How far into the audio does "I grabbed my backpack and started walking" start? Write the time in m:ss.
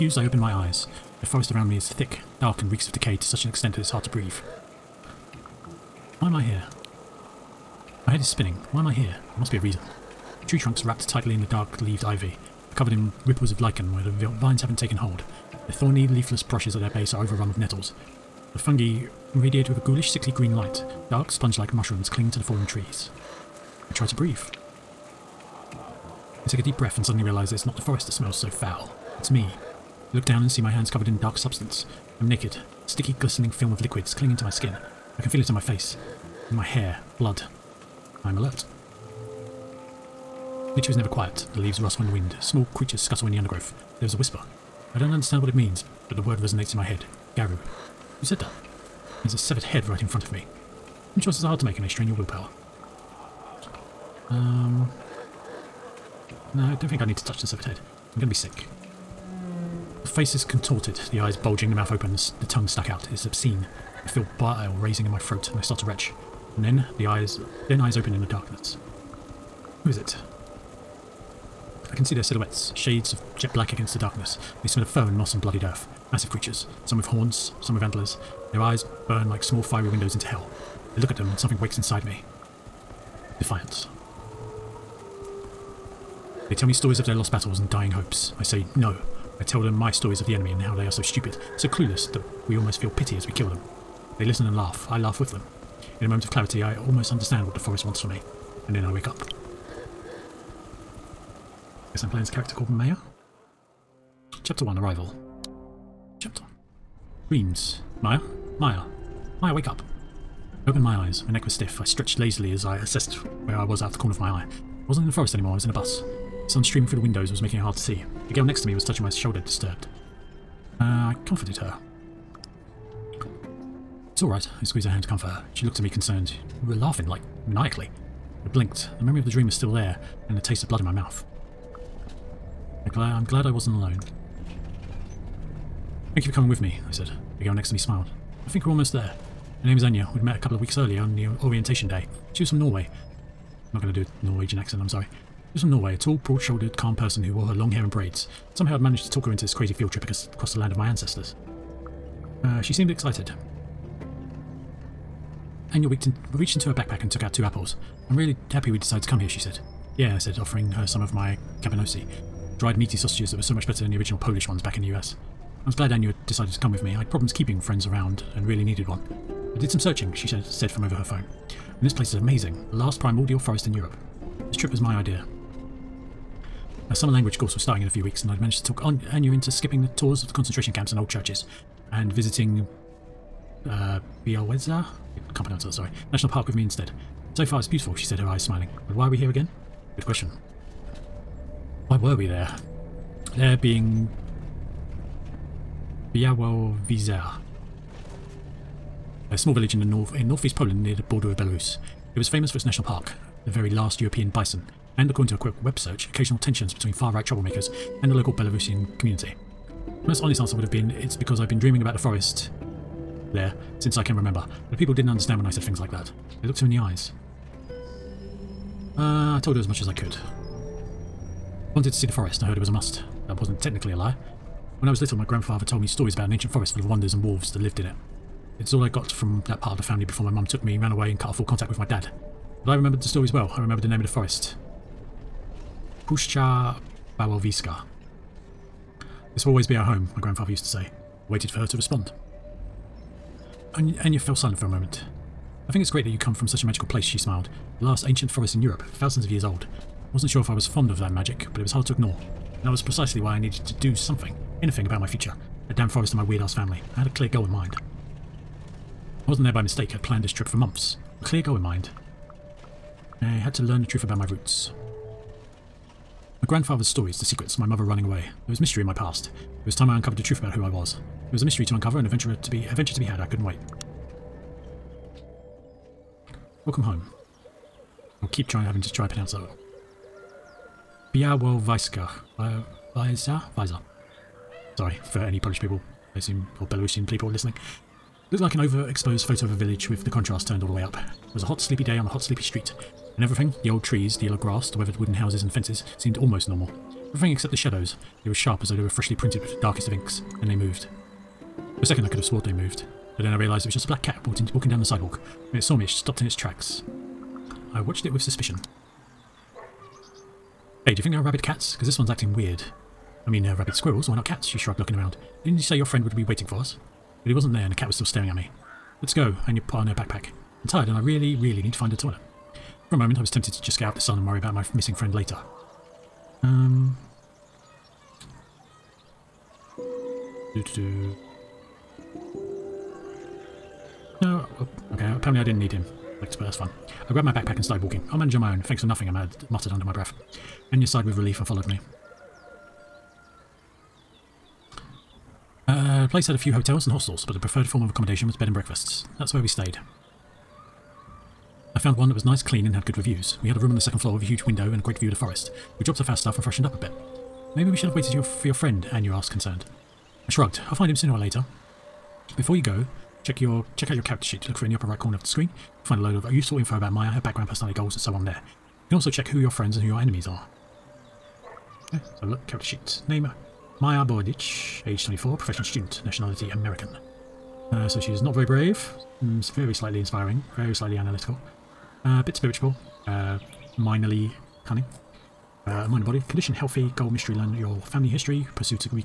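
5:37.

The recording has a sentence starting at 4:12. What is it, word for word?
And that was precisely why I needed to do something, anything about my future.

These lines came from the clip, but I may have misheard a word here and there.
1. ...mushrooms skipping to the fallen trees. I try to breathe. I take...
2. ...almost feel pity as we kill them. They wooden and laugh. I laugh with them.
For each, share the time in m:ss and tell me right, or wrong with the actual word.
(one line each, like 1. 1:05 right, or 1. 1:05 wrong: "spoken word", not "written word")
1. 0:21 wrong: "cling", not "skipping"
2. 1:32 wrong: "listen", not "wooden".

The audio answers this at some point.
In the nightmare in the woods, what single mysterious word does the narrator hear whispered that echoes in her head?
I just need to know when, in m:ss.
0:47.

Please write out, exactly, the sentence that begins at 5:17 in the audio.
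But he wasn't there and the cat was still staring at me.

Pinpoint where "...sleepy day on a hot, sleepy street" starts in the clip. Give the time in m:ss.
4:51.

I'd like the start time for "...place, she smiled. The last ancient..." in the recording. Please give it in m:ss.
4:06.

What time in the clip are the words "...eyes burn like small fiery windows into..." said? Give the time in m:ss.
1:18.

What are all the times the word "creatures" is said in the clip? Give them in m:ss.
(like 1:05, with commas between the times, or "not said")
0:42, 1:16.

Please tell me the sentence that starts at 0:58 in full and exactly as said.
I'm going to be sick face is contorted, the eyes bulging, the mouth open, the, the tongue stuck out.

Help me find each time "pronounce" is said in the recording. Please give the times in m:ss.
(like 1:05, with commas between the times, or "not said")
3:05, 4:39.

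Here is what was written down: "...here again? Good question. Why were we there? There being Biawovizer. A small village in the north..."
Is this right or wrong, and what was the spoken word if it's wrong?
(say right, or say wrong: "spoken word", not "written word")
right.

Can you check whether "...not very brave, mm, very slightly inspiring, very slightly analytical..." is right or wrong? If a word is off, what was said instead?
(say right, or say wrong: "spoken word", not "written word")
right.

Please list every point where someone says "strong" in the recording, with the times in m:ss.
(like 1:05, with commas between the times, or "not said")
not said.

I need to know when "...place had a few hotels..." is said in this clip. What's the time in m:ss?
5:46.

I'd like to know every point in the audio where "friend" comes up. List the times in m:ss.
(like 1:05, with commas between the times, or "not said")
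2:47, 5:15, 5:24, 5:58, 6:09.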